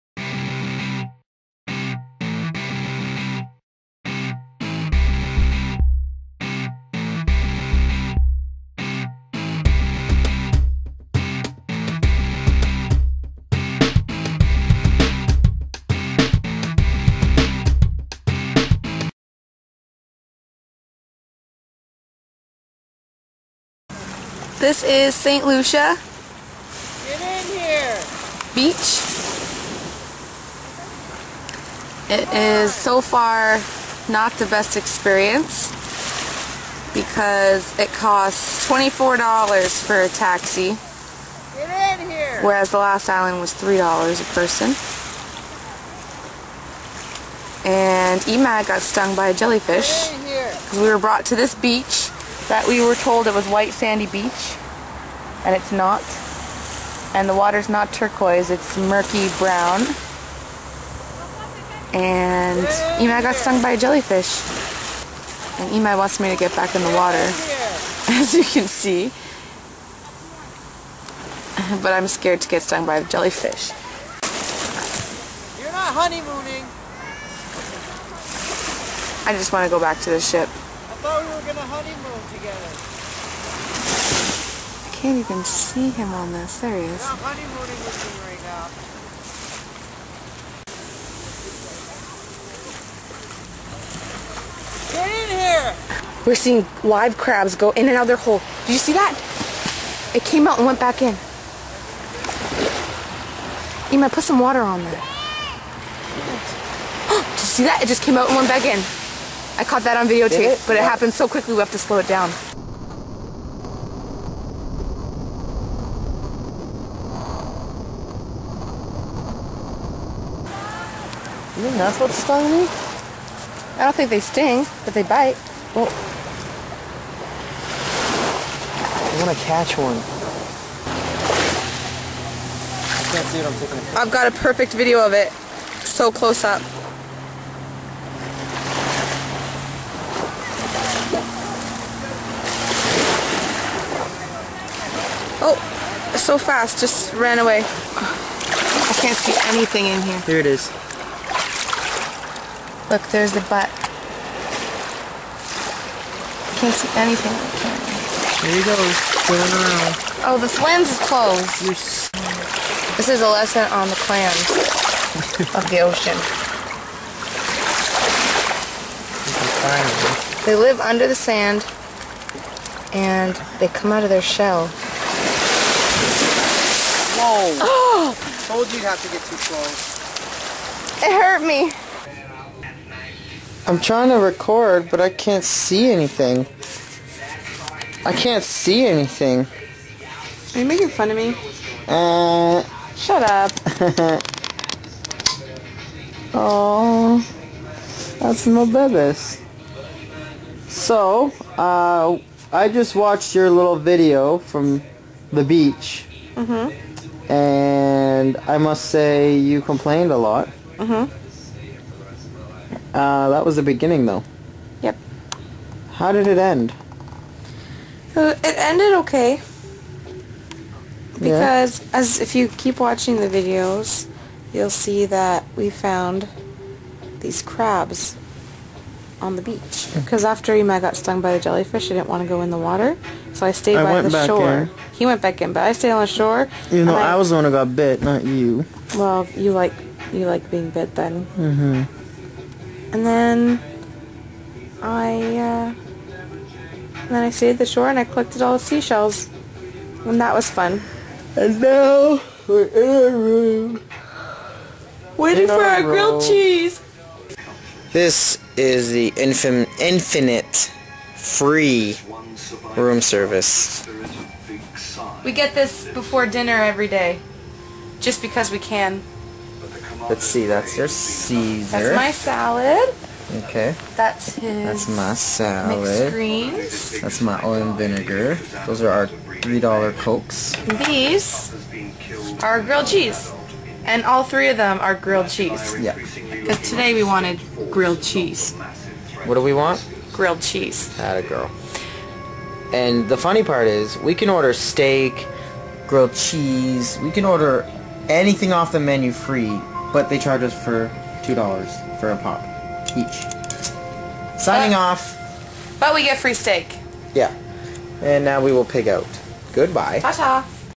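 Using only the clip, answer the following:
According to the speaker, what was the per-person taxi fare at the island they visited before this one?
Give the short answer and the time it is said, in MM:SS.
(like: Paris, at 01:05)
$3 a person, at 00:43.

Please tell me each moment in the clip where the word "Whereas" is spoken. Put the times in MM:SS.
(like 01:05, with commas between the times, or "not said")
00:42.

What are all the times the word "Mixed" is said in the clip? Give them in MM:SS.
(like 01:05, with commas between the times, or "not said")
04:35.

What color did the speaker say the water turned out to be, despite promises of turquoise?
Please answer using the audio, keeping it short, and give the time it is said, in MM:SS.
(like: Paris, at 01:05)
murky brown, at 00:58.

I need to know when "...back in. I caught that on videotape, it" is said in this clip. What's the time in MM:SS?
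01:48.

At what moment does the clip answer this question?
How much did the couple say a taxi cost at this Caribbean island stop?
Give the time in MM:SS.
00:38.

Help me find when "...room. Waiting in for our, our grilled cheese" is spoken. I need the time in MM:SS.
04:13.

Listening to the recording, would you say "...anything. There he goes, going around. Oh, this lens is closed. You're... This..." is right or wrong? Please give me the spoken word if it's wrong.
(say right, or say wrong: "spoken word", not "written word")
right.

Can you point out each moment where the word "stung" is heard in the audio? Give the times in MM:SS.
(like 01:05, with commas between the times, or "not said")
00:48, 01:03, 01:12, 02:02, 03:50.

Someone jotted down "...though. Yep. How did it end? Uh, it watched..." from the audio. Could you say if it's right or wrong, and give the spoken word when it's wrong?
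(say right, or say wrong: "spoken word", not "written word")
wrong: "ended", not "watched".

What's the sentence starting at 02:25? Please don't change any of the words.
Oh, so fast, just ran away.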